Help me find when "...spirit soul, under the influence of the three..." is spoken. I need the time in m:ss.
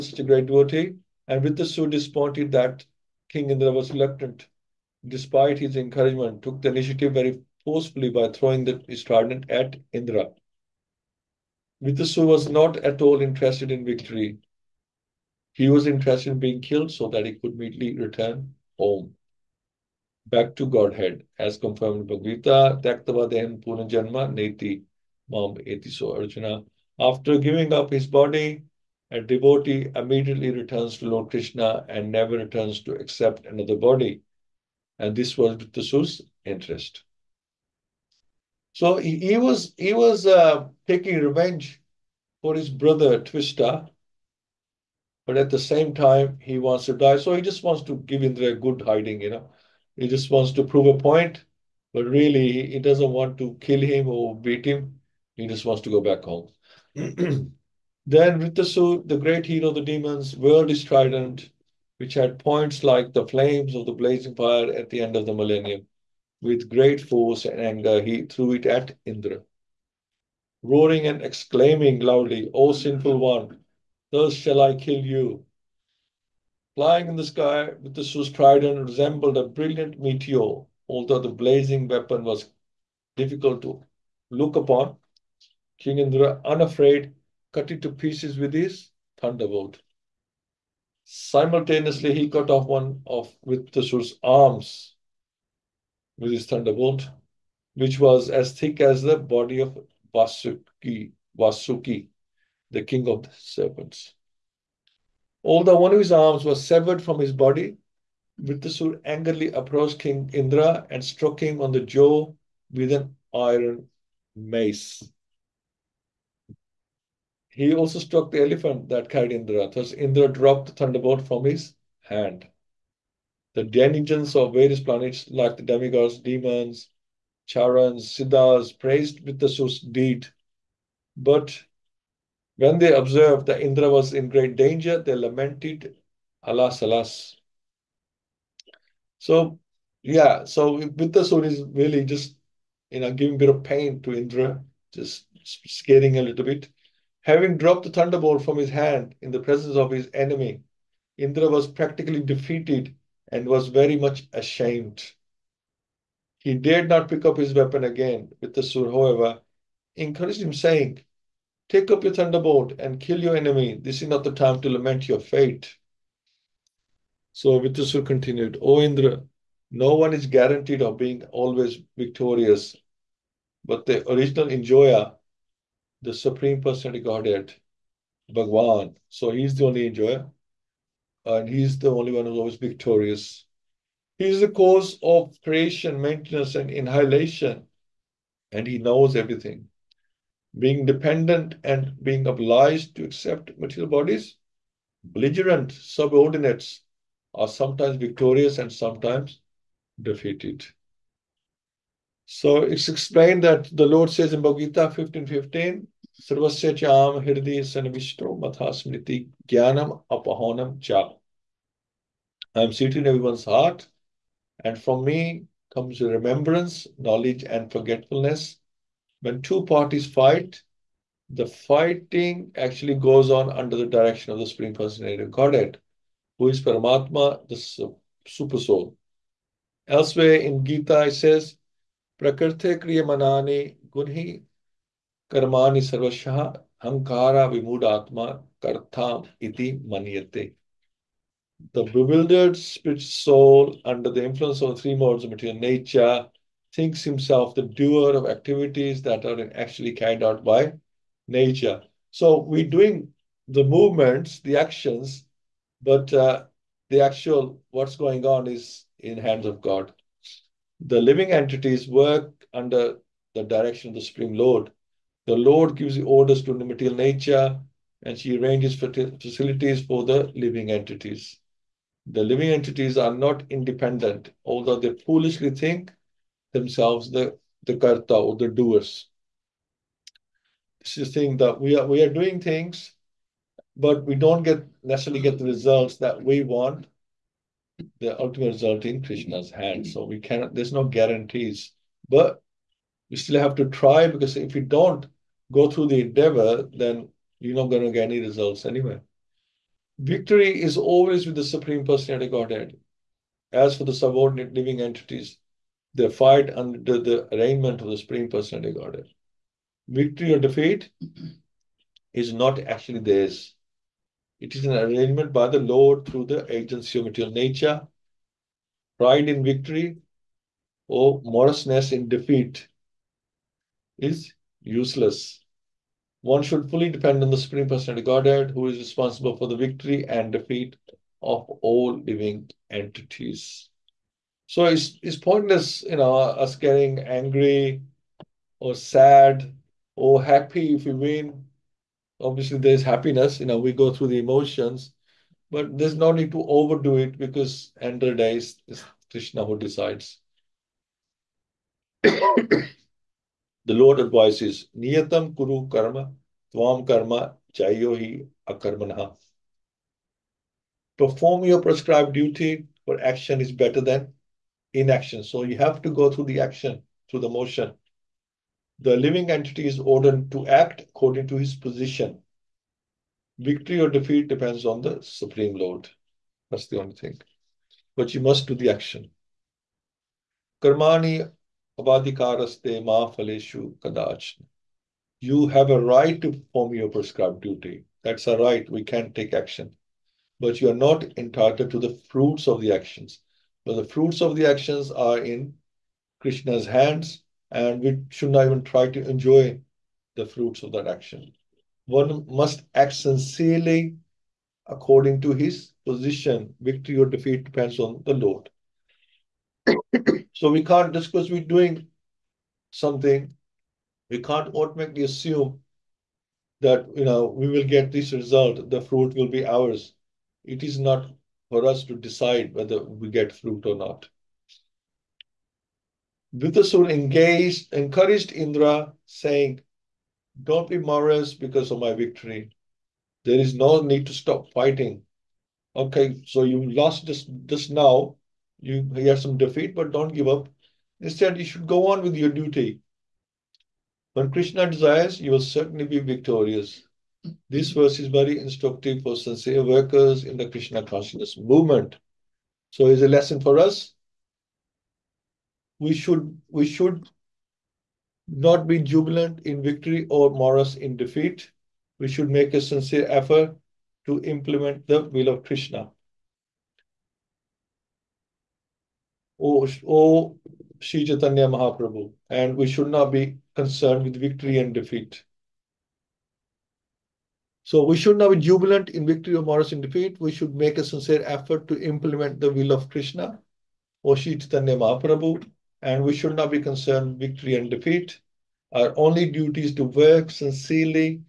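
4:02.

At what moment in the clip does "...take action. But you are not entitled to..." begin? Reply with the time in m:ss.
6:29.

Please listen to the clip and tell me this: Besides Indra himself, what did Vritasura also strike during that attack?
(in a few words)
The elephant.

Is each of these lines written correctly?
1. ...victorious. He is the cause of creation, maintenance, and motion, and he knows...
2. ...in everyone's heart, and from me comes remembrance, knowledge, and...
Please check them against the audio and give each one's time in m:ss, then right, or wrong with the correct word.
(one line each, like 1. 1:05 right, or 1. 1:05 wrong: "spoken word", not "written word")
1. 3:02 wrong: "inhalation", not "motion"
2. 3:32 right.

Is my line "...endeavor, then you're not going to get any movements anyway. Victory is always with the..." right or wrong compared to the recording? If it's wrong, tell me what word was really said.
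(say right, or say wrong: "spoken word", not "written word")
wrong: "results", not "movements".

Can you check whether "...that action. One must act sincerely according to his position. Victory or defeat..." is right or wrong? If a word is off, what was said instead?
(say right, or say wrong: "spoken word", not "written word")
right.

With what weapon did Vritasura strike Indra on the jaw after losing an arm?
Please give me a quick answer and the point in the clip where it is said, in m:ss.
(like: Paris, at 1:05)
Iron mace, at 1:53.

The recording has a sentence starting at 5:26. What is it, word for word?
One should fully depend on the Supreme Personality Godhead, who is responsible for the victory and defeat of all living entities.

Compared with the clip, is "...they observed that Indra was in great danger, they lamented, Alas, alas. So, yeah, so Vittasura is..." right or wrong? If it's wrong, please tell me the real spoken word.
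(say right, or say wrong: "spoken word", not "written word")
right.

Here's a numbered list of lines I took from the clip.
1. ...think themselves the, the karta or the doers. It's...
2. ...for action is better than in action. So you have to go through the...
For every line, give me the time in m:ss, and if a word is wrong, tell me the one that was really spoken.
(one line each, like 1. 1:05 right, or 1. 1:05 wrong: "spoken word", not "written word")
1. 4:35 right
2. 6:02 right.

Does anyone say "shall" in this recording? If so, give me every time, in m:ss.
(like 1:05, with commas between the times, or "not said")
1:14.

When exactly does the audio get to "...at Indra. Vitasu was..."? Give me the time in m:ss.
0:09.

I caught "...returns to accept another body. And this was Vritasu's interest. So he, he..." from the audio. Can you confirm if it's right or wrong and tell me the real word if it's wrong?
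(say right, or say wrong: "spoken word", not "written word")
right.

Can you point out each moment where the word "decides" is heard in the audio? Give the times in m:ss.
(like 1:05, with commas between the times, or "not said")
5:49, 7:01.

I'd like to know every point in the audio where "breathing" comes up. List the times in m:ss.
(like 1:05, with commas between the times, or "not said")
not said.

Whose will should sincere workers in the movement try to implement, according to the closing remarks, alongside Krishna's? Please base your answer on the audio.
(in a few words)
Sri Chaitanya Mahaprabhu.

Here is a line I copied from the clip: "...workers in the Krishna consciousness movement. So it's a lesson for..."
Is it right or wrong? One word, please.
right.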